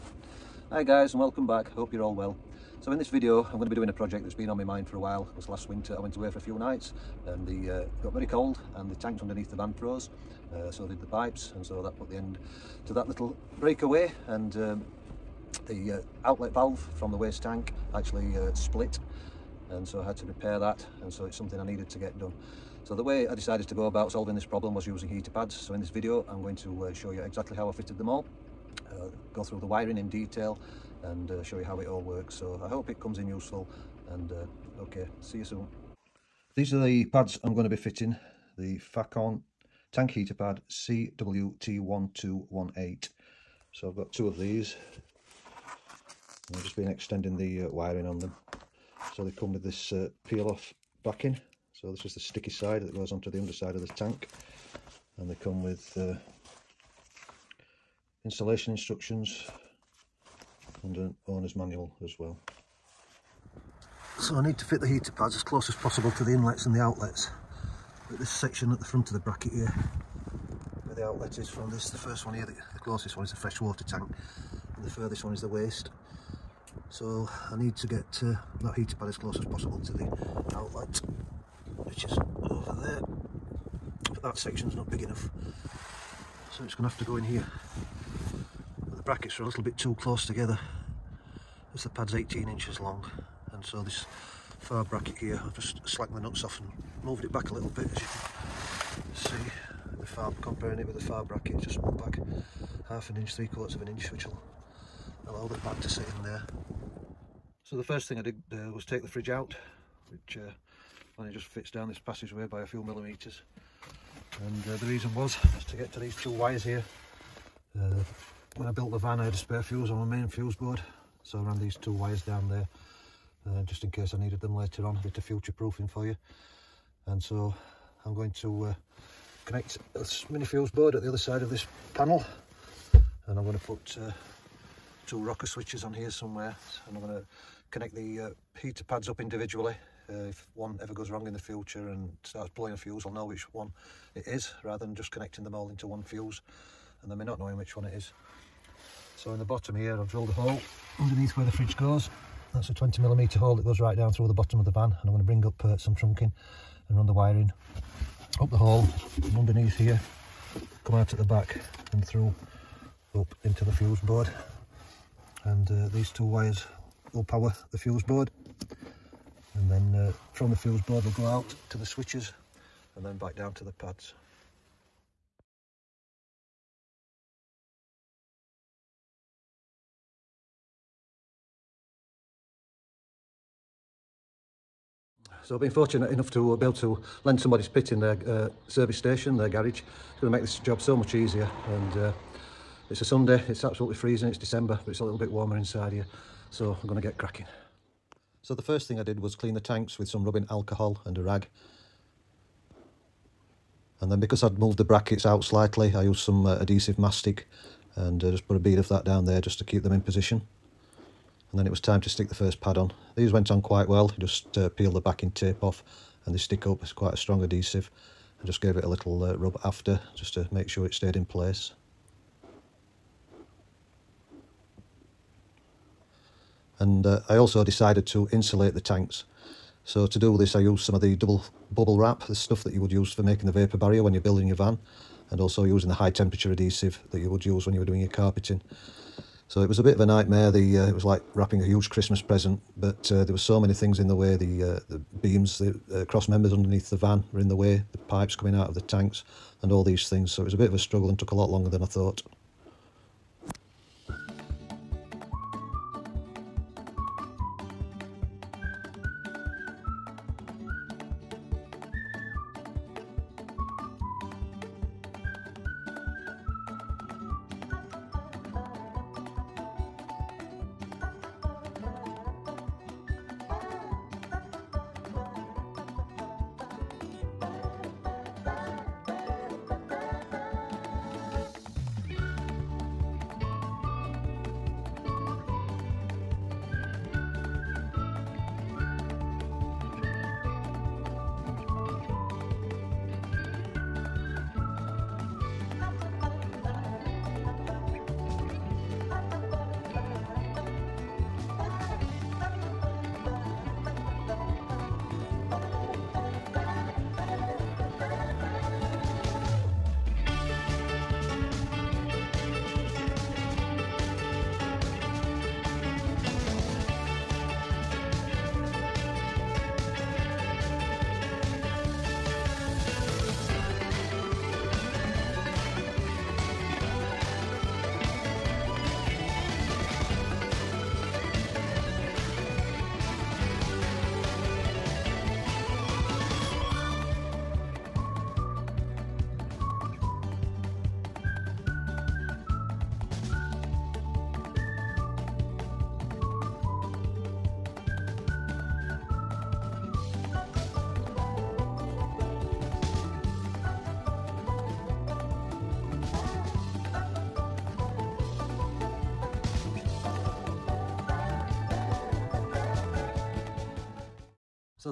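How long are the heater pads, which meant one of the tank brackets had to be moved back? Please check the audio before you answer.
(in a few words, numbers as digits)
18 inches.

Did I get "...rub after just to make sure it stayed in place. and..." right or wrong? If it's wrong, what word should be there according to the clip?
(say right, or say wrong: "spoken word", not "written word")
right.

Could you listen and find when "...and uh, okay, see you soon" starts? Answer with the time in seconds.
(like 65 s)
34 s.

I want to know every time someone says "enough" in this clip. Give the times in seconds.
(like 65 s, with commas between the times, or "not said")
85 s, 186 s.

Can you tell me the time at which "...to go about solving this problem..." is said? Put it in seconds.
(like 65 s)
23 s.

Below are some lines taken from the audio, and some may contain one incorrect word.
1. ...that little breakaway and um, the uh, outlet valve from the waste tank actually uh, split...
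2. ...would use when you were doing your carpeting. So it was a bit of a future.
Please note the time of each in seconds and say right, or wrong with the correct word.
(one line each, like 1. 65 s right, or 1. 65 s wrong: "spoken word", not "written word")
1. 12 s right
2. 237 s wrong: "nightmare", not "future".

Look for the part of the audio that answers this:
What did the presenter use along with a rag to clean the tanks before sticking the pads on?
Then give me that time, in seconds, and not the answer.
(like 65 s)
200 s.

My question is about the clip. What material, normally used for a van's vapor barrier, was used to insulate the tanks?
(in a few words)
double bubble wrap.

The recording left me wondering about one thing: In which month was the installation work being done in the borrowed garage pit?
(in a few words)
December.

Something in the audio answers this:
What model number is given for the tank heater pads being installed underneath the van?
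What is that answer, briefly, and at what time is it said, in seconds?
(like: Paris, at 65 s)
CWT1218, at 40 s.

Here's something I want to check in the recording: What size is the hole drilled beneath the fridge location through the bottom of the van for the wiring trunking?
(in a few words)
20 millimeter.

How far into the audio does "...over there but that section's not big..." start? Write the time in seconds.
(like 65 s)
82 s.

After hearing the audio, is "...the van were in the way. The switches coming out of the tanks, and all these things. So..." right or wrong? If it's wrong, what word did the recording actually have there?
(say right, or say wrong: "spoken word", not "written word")
wrong: "pipes", not "switches".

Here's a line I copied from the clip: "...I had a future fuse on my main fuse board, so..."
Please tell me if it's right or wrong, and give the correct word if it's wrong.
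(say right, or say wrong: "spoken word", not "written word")
wrong: "spare", not "future".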